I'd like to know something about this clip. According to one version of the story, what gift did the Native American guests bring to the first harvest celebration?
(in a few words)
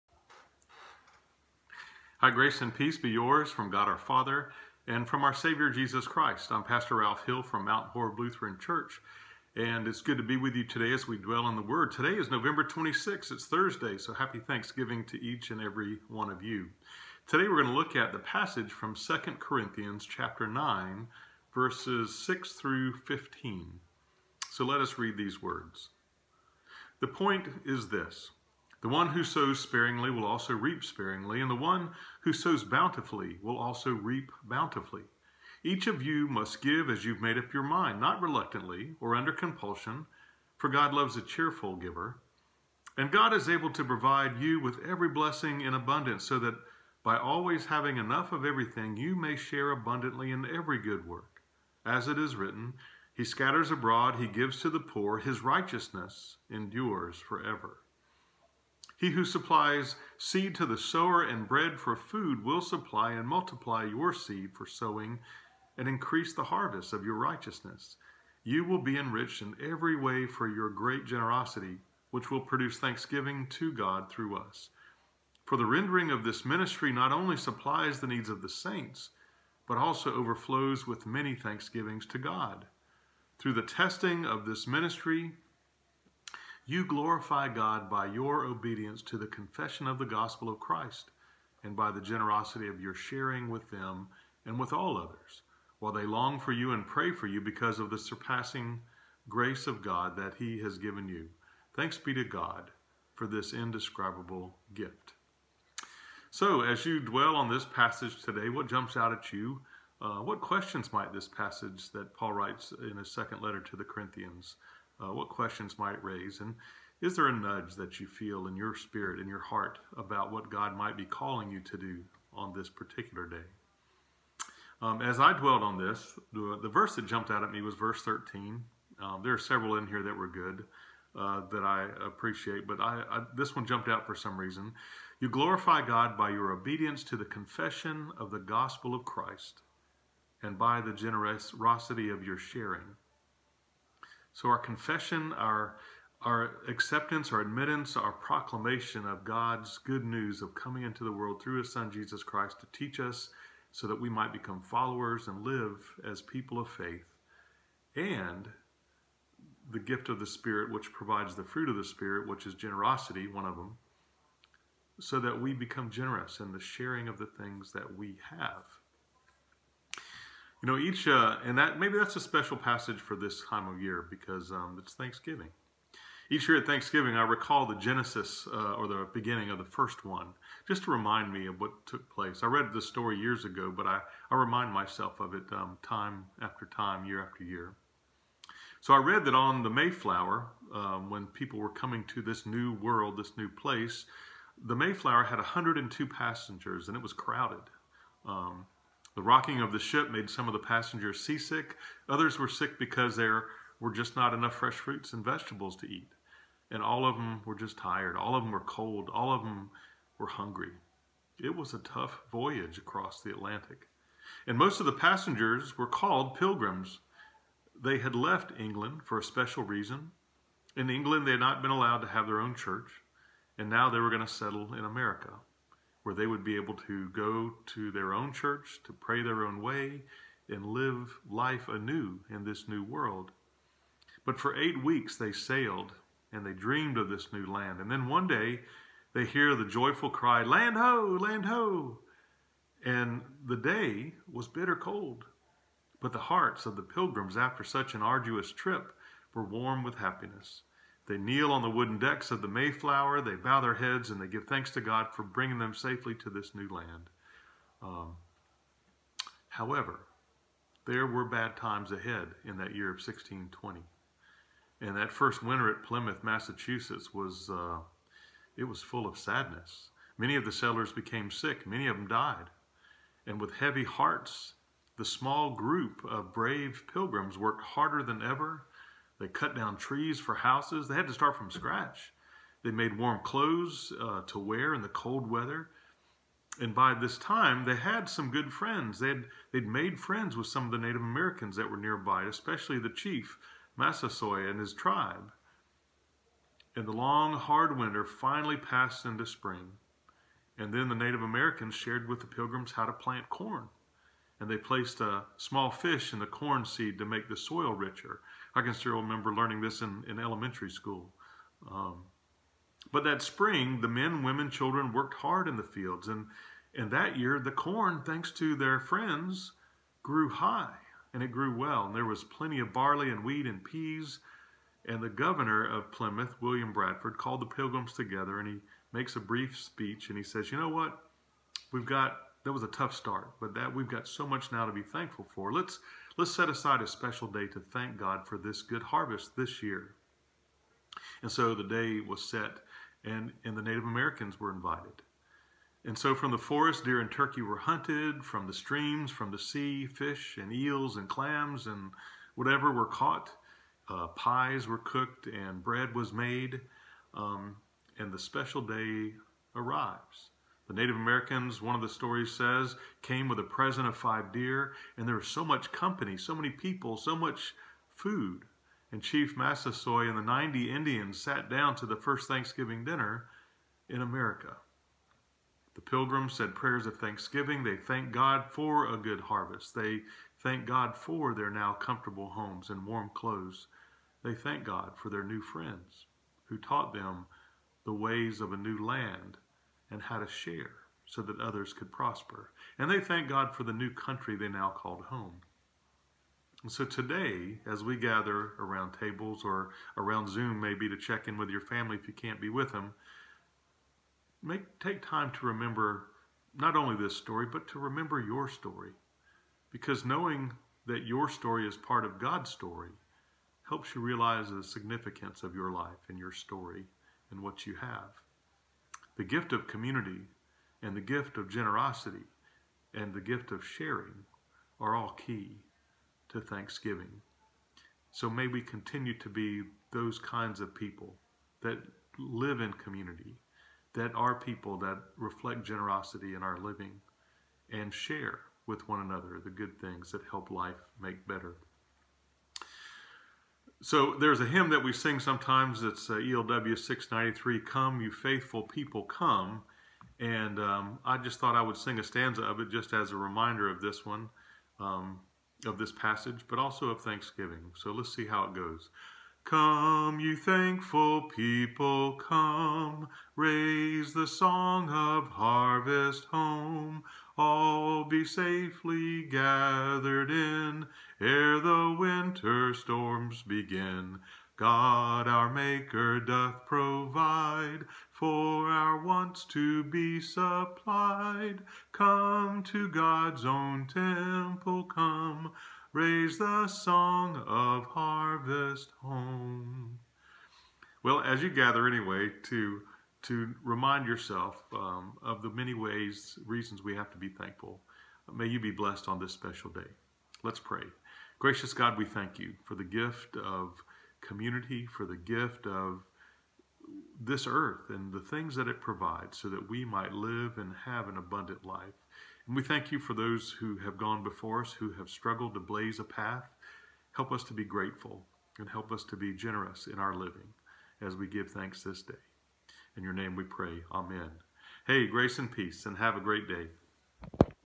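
5 deer.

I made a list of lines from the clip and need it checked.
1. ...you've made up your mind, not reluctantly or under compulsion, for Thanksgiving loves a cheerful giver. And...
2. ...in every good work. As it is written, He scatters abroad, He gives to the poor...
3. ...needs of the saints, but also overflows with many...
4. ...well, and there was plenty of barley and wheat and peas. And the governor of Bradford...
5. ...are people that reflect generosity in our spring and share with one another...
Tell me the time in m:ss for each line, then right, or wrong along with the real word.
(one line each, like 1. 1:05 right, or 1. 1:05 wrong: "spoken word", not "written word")
1. 0:37 wrong: "God", not "Thanksgiving"
2. 0:50 right
3. 1:18 right
4. 5:21 wrong: "Plymouth", not "Bradford"
5. 7:14 wrong: "living", not "spring".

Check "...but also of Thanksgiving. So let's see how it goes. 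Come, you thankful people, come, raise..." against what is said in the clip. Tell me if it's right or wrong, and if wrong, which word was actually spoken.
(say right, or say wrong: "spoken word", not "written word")
right.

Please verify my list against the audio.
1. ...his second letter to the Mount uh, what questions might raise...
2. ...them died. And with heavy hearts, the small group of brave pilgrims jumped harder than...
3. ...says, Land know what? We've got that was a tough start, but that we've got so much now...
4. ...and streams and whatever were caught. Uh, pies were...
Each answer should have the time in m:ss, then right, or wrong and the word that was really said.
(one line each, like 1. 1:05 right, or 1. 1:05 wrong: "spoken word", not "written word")
1. 1:52 wrong: "Corinthians", not "Mount"
2. 4:31 wrong: "worked", not "jumped"
3. 5:30 wrong: "You", not "Land"
4. 5:50 wrong: "clams", not "streams".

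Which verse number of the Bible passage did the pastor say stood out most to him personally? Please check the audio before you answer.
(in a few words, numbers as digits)
13.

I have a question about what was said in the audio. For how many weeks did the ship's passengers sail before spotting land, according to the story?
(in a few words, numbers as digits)
8.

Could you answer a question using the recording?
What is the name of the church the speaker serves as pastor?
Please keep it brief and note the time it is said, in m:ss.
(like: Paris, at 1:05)
Mount Horeb Lutheran Church, at 0:07.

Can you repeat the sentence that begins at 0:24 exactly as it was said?
So let us read these words.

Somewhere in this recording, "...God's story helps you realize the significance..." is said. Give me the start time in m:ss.
6:52.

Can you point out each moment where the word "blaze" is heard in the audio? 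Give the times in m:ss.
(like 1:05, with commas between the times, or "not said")
8:35.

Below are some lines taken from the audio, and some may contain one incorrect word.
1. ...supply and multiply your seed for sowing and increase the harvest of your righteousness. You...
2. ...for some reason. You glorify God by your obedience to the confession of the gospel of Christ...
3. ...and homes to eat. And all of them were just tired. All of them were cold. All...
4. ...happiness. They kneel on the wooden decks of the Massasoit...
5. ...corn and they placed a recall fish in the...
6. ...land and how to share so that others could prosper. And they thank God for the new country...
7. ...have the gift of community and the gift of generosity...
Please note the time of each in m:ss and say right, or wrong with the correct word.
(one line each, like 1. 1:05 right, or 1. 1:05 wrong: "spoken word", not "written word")
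1. 1:02 right
2. 2:14 right
3. 3:25 wrong: "vegetables", not "homes"
4. 4:09 wrong: "Mayflower", not "Massasoit"
5. 5:03 wrong: "small", not "recall"
6. 6:28 right
7. 6:57 right.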